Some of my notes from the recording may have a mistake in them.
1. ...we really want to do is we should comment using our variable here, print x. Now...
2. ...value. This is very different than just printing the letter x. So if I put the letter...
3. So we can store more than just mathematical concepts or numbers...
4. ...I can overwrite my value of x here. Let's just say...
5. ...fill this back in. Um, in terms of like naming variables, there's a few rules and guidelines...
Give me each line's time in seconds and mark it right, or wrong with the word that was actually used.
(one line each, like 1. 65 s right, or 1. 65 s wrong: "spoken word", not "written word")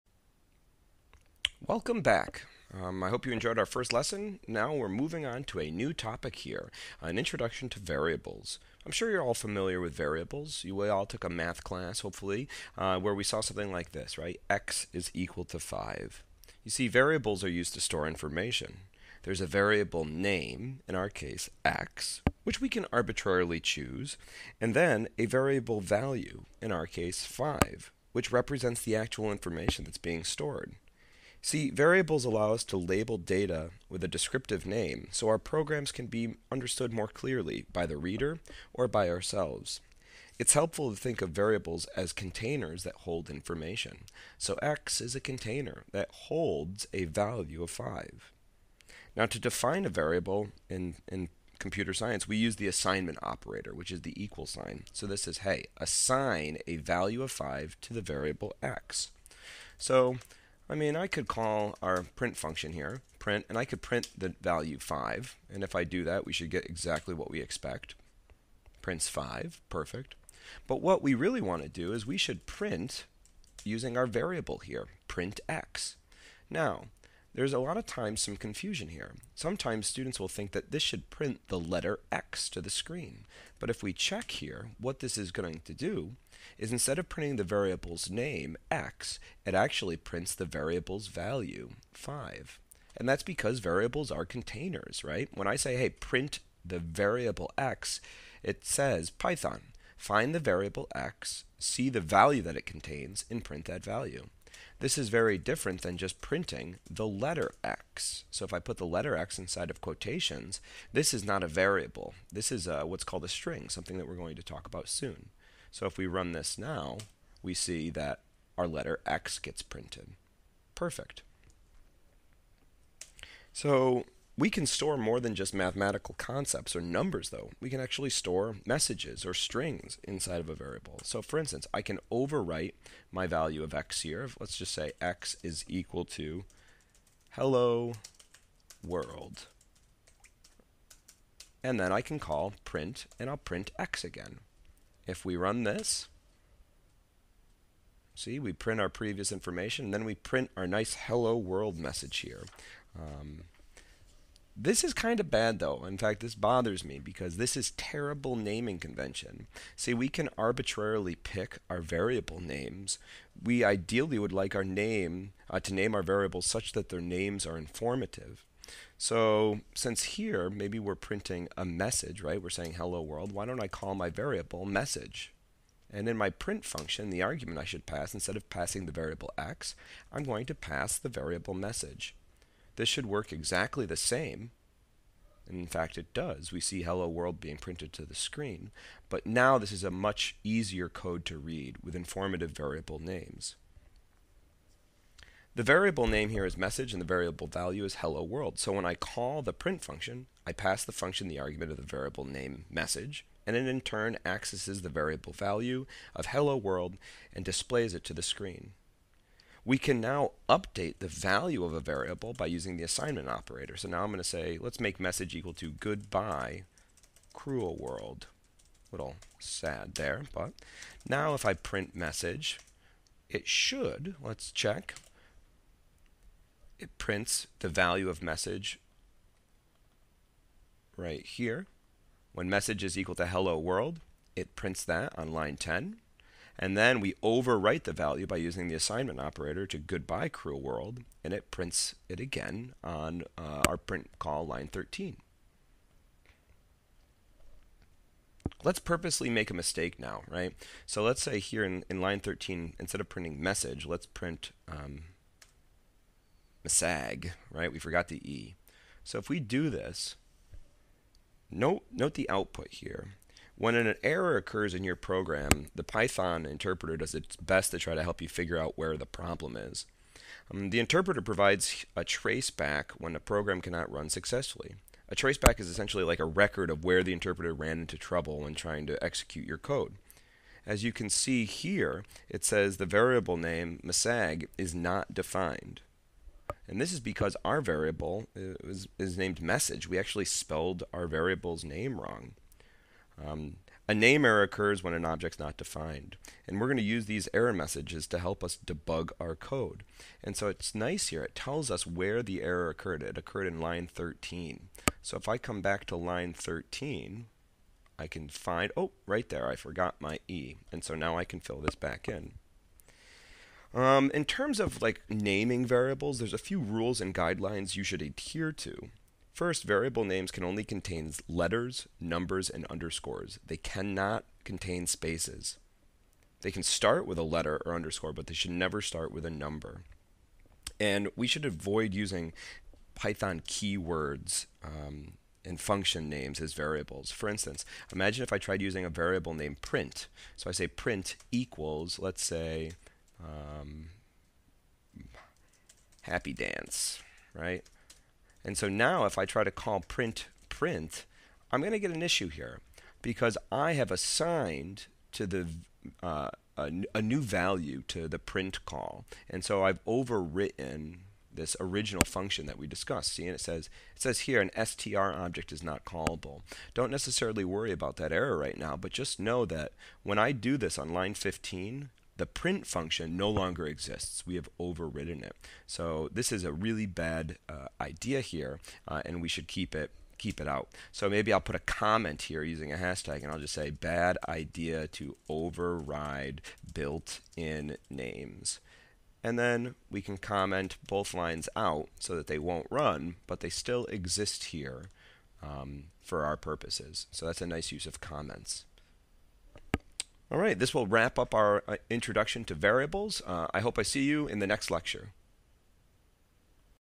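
1. 71 s wrong: "print", not "comment"
2. 103 s right
3. 123 s right
4. 131 s right
5. 311 s right.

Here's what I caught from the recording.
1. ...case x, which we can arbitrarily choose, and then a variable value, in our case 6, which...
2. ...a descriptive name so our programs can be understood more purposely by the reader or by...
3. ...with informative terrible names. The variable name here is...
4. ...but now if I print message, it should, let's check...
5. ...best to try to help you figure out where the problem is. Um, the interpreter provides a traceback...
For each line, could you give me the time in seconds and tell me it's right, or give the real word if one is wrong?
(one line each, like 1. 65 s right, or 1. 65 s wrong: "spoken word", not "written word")
1. 21 s wrong: "5", not "6"
2. 34 s wrong: "clearly", not "purposely"
3. 191 s wrong: "variable", not "terrible"
4. 220 s right
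5. 267 s right.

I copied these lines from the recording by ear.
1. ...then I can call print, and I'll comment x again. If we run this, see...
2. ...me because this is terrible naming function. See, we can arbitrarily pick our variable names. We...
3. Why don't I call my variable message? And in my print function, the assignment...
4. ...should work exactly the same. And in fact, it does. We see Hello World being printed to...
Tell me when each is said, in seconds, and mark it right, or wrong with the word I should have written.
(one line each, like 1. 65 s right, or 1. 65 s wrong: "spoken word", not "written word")
1. 141 s wrong: "print", not "comment"
2. 156 s wrong: "convention", not "function"
3. 173 s wrong: "argument", not "assignment"
4. 182 s right.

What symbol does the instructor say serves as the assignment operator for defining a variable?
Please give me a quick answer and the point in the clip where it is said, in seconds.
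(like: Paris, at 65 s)
The equal sign, at 54 s.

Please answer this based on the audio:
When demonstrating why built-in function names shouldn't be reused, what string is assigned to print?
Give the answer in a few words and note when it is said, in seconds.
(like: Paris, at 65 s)
happy dance, at 346 s.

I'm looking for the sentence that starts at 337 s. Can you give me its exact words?
For instance, imagine if I tried using a variable named print.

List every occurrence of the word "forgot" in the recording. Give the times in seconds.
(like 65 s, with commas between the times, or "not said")
257 s, 309 s.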